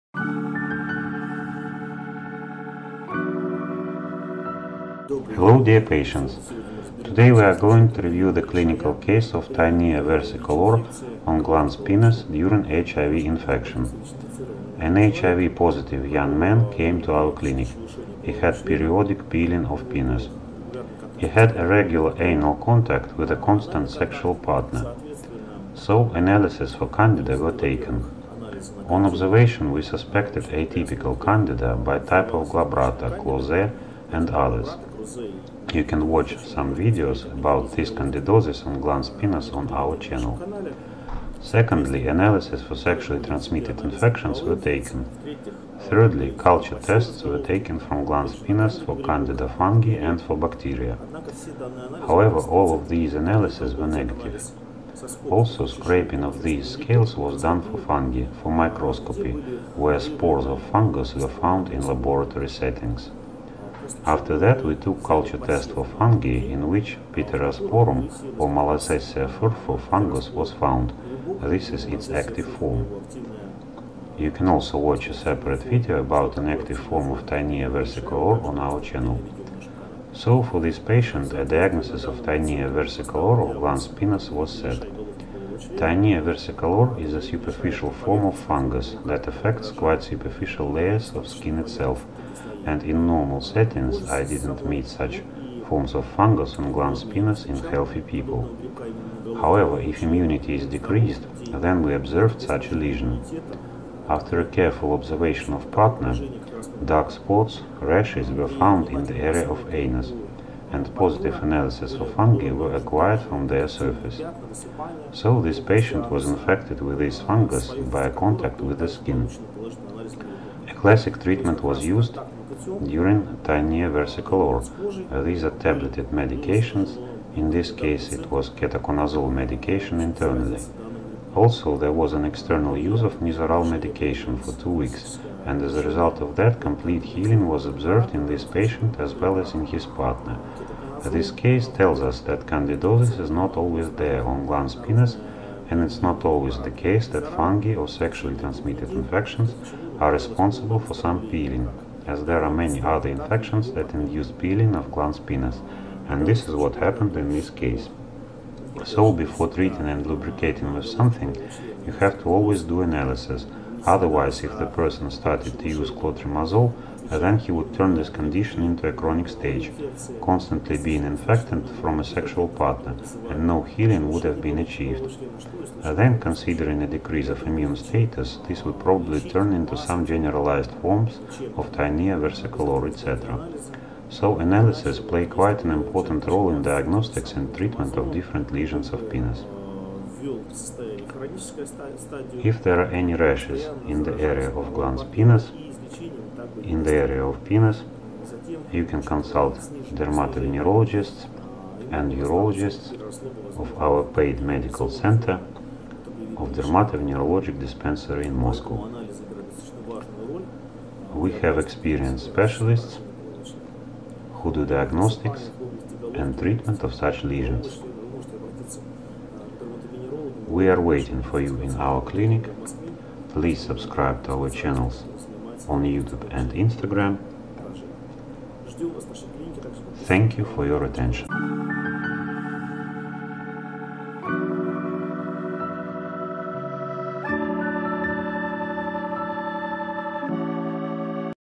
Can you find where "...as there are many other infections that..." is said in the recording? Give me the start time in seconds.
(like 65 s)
152 s.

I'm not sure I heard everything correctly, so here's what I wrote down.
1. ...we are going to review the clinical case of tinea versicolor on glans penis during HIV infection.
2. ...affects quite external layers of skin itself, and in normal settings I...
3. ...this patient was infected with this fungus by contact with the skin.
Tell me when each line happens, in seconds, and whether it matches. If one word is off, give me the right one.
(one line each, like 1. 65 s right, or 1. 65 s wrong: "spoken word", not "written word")
1. 7 s right
2. 89 s wrong: "superficial", not "external"
3. 115 s right.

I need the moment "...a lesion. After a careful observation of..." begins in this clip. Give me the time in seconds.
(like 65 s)
102 s.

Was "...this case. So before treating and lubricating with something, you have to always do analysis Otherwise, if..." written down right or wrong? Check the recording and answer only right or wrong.
right.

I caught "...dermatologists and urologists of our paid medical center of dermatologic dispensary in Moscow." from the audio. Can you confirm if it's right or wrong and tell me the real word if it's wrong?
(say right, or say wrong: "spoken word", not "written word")
right.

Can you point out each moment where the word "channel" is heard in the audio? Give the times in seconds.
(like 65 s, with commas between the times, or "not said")
39 s, 78 s, 224 s.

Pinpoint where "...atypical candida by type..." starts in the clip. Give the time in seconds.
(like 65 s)
30 s.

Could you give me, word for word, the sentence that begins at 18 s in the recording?
He had periodic peeling of penis.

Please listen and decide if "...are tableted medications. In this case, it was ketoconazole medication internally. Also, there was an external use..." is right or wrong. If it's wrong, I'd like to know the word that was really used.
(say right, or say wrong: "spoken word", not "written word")
right.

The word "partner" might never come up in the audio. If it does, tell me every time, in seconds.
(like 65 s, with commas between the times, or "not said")
24 s, 105 s, 139 s, 172 s.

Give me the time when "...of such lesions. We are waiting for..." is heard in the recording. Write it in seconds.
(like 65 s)
216 s.